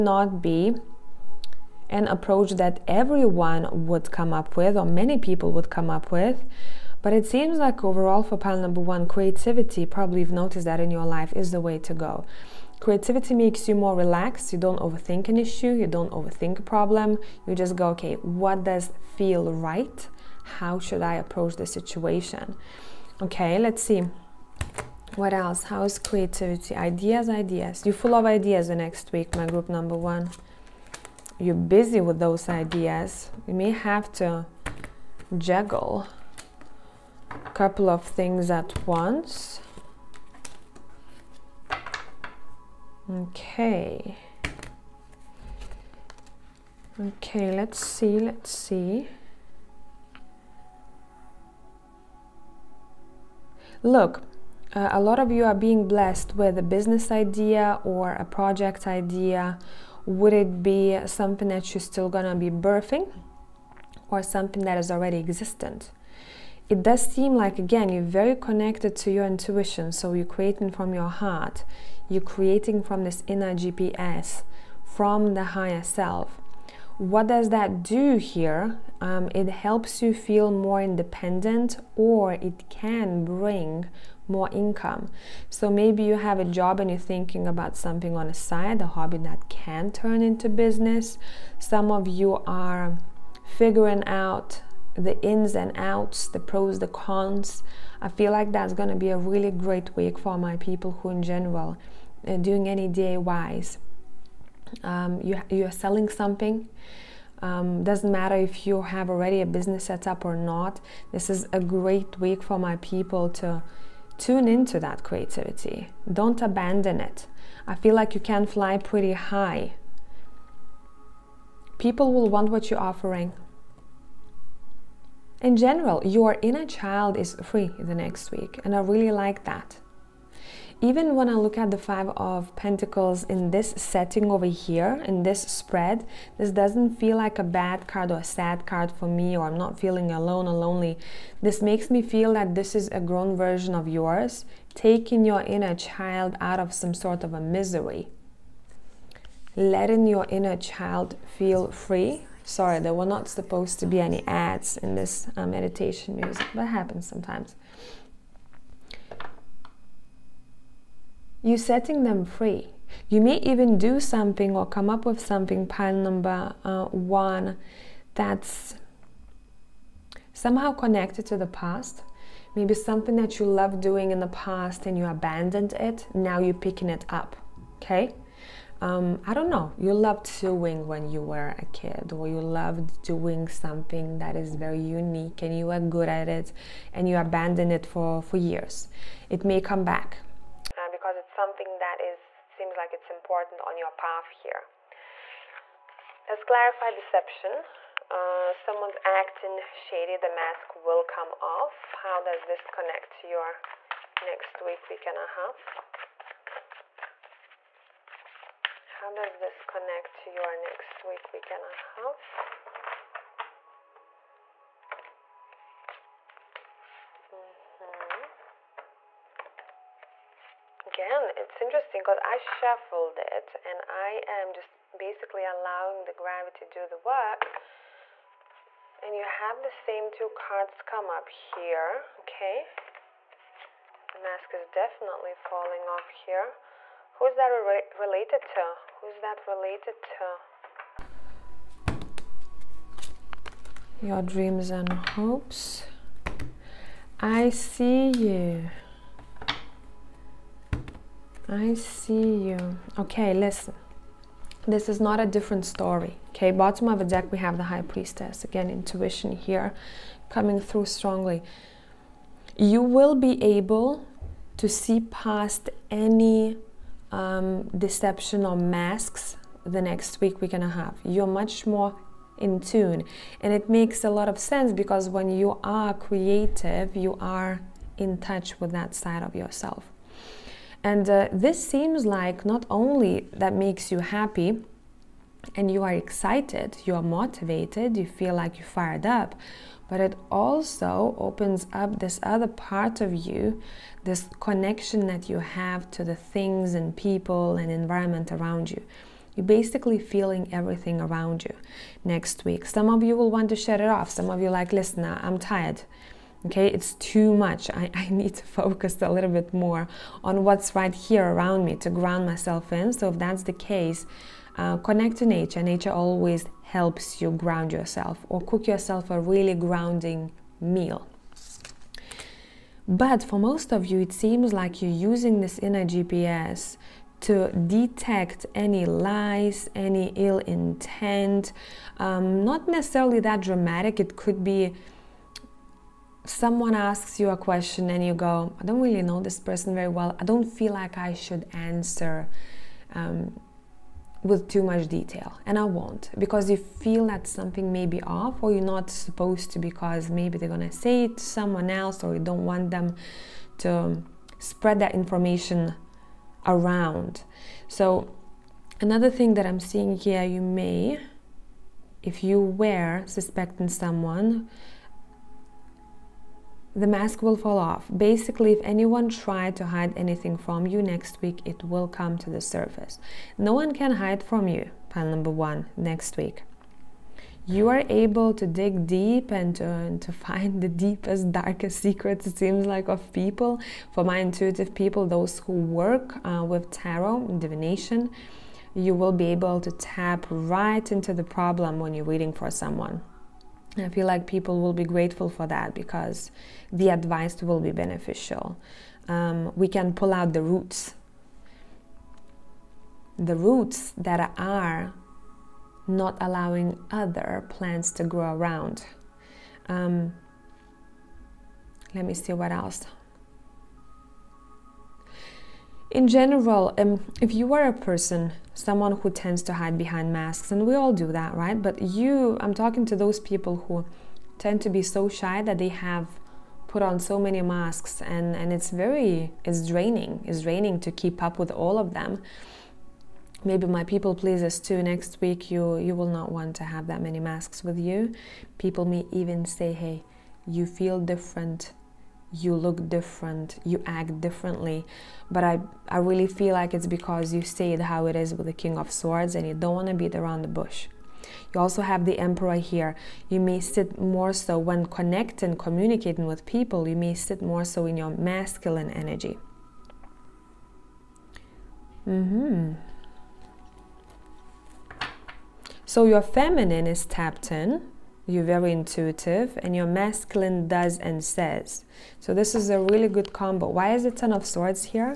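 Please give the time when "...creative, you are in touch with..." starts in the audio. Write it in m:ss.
4:35.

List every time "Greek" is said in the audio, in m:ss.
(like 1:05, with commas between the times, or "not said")
not said.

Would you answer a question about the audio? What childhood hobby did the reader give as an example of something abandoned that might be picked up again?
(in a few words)
Sewing.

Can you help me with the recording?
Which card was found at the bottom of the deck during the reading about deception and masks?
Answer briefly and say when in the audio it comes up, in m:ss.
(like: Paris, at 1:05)
The High Priestess, at 4:17.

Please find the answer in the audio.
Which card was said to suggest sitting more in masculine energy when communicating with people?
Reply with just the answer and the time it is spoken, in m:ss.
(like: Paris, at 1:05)
The Emperor, at 7:32.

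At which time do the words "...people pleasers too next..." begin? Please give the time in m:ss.
7:13.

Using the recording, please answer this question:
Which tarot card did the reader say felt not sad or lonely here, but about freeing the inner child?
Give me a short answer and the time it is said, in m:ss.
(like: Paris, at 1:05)
Five of Pentacles, at 2:11.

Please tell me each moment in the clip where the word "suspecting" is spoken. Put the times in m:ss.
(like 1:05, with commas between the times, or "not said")
6:03.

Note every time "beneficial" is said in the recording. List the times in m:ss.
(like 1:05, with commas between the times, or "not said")
6:37.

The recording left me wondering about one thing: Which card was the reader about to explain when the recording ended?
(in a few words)
Ten of Swords.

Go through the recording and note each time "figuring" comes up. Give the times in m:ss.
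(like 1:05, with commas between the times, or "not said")
1:33.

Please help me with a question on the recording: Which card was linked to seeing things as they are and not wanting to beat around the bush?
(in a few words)
King of Swords.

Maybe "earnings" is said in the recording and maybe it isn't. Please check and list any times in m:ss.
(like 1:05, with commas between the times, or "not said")
not said.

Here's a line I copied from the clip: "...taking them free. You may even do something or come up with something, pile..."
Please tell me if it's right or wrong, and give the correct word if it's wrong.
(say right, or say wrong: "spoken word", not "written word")
wrong: "setting", not "taking".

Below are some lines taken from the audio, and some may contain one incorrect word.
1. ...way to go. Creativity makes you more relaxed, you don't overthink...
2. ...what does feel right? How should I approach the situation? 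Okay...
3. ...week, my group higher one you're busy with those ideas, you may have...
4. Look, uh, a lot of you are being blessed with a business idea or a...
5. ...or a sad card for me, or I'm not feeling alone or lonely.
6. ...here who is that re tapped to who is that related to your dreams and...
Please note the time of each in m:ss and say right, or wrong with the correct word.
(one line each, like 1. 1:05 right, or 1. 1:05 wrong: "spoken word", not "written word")
1. 0:11 right
2. 0:18 right
3. 0:29 wrong: "number", not "higher"
4. 0:53 right
5. 2:18 right
6. 3:56 wrong: "related", not "tapped".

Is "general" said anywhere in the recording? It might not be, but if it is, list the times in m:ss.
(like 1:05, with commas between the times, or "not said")
1:41, 2:05, 6:56.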